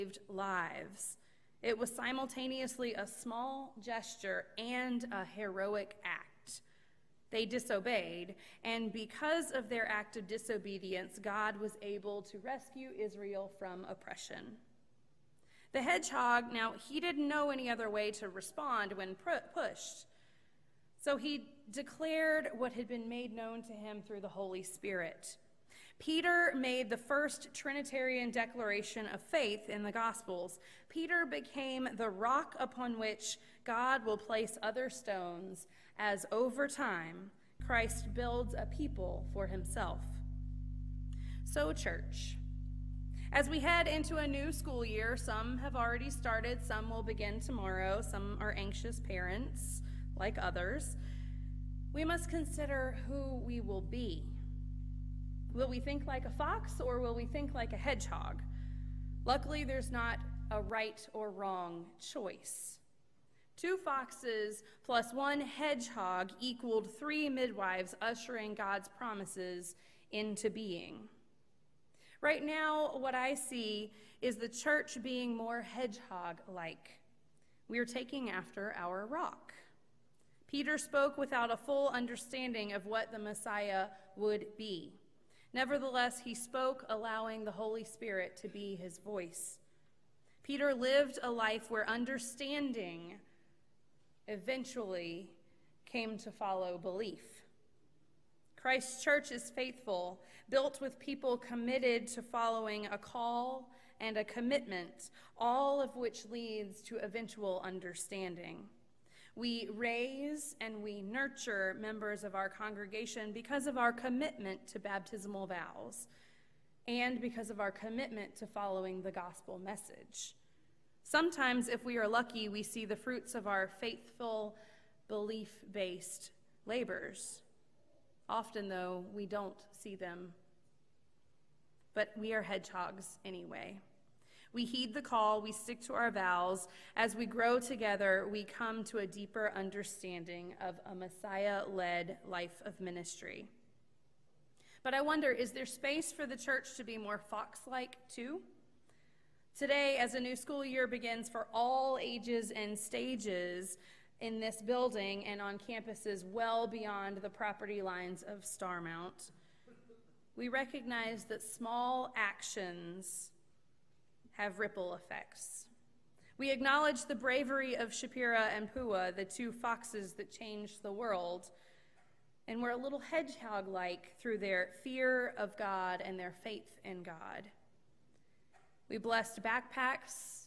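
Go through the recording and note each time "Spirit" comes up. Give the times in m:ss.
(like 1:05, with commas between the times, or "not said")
0:24, 1:27.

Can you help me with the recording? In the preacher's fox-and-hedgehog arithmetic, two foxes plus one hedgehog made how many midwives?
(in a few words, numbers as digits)
3.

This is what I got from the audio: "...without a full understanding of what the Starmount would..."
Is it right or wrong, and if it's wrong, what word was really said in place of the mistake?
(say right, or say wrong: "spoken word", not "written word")
wrong: "Messiah", not "Starmount".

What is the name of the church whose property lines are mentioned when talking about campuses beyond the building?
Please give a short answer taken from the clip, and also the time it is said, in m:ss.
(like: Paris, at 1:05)
Starmount, at 2:38.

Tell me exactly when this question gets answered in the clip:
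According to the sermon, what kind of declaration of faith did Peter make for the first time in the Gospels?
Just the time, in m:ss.
0:27.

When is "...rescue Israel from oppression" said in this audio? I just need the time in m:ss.
0:12.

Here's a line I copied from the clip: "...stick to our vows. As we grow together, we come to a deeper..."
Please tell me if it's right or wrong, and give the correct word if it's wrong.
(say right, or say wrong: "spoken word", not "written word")
right.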